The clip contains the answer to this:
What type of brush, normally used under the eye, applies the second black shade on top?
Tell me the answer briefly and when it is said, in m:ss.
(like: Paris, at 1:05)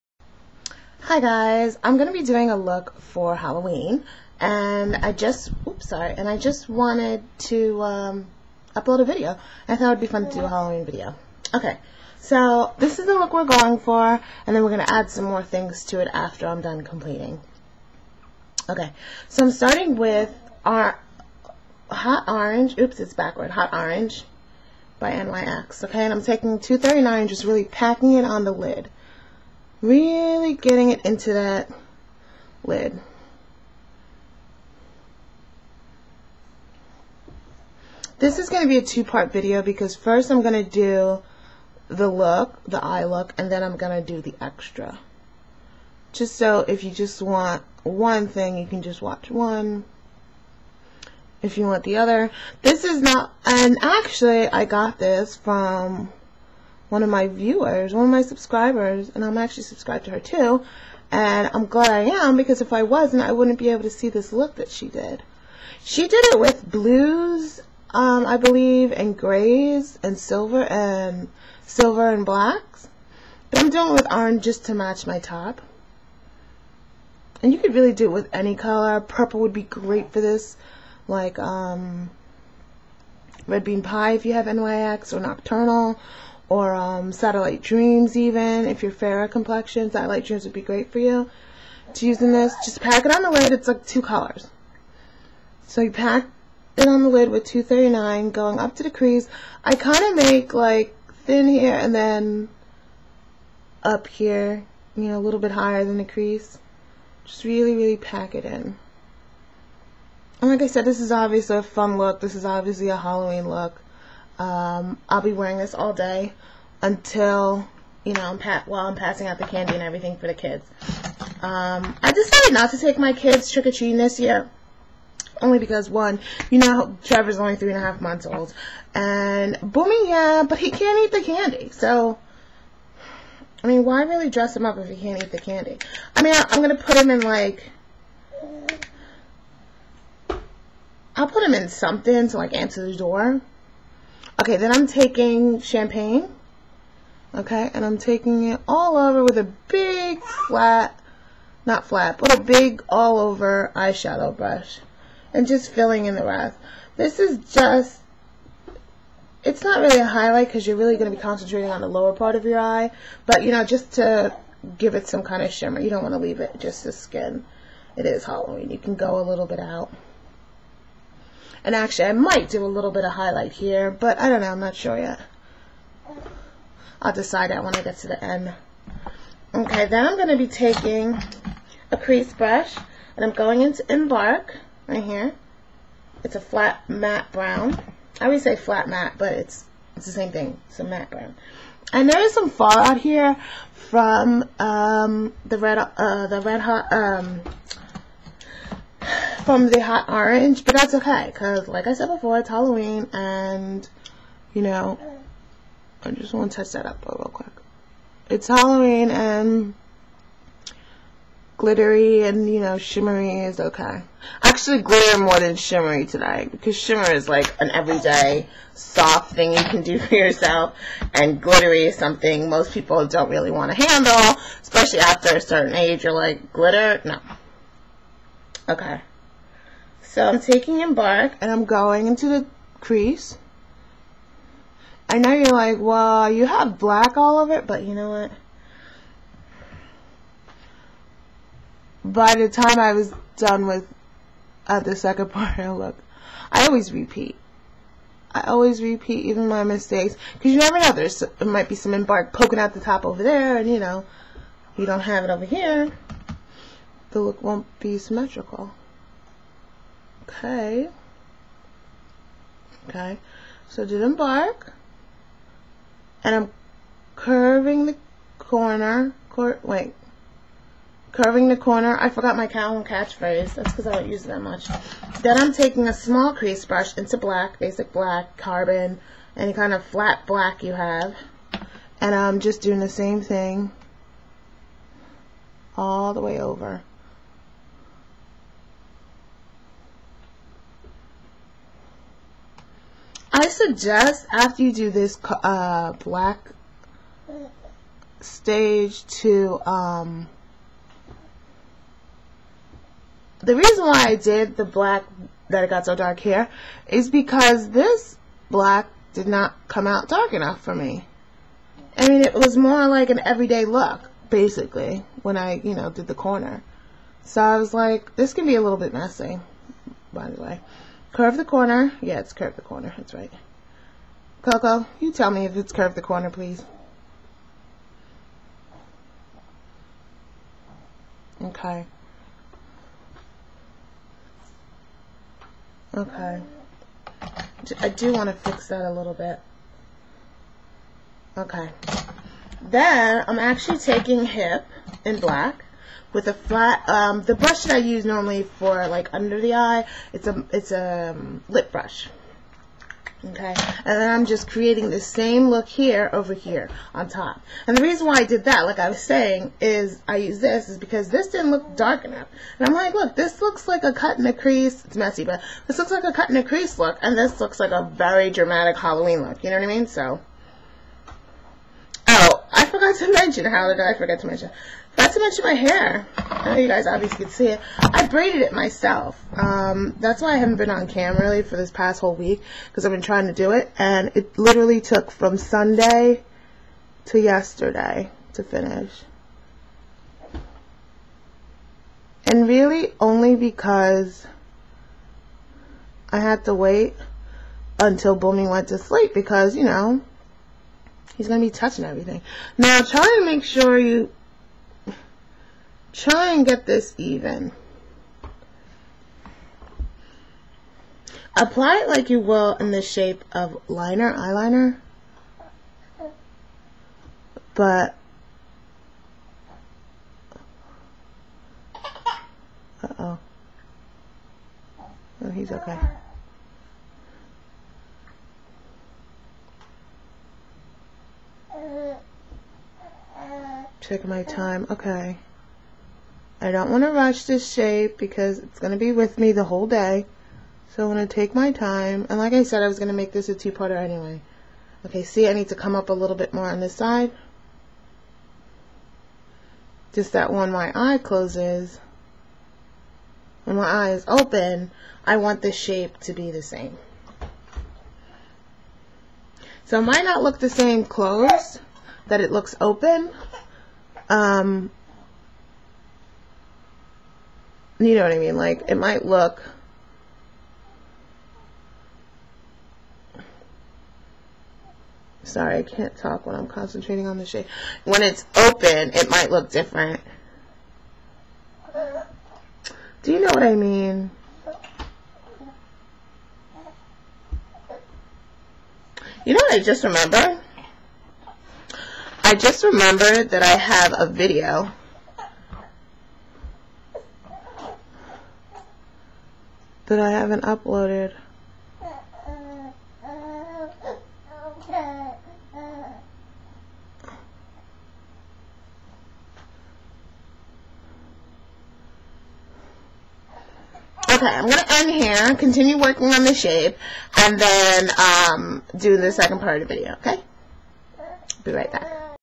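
Lip brush, at 5:51.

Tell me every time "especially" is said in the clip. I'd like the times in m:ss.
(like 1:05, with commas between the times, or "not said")
3:44.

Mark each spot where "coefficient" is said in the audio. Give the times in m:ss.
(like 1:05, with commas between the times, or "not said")
not said.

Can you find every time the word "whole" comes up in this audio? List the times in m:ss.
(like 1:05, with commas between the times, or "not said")
6:22, 7:19.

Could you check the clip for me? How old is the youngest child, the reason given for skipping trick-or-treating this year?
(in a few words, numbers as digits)
3 and a half months.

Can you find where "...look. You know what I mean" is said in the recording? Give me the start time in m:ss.
6:09.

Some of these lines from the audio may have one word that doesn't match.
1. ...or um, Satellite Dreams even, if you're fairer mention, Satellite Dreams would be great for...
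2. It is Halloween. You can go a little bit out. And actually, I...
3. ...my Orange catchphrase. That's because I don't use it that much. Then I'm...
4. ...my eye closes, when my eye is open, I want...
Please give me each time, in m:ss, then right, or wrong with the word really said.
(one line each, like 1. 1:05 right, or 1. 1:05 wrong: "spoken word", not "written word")
1. 1:26 wrong: "complexion", not "mention"
2. 2:47 right
3. 4:32 wrong: "Calvin", not "Orange"
4. 7:30 right.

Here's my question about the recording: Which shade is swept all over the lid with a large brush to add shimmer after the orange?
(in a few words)
Champagne.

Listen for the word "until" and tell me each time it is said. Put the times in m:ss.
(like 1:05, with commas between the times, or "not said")
1:56, 6:37.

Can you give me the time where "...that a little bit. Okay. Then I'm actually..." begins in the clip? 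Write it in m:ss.
5:38.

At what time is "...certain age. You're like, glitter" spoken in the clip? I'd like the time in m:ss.
3:45.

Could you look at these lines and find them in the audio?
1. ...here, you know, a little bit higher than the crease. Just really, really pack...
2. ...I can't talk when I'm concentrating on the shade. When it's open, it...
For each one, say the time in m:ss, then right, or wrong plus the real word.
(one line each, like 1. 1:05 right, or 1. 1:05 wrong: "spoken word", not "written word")
1. 1:44 right
2. 7:55 right.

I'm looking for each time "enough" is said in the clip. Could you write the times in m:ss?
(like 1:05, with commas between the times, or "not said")
5:10, 6:02.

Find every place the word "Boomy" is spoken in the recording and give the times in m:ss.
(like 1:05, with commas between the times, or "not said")
2:09, 6:38.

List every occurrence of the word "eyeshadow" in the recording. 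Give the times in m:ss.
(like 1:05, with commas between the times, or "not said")
2:33.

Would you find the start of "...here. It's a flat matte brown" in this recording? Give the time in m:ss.
3:05.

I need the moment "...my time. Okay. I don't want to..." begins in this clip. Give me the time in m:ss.
7:14.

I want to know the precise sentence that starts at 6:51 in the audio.
Apply it like you will in the shape of liner, eyeliner.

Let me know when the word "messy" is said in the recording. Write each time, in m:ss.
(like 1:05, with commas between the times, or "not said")
5:18, 6:04.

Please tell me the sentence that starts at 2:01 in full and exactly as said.
Um, I decided not to take my kids trick-or-treating this year.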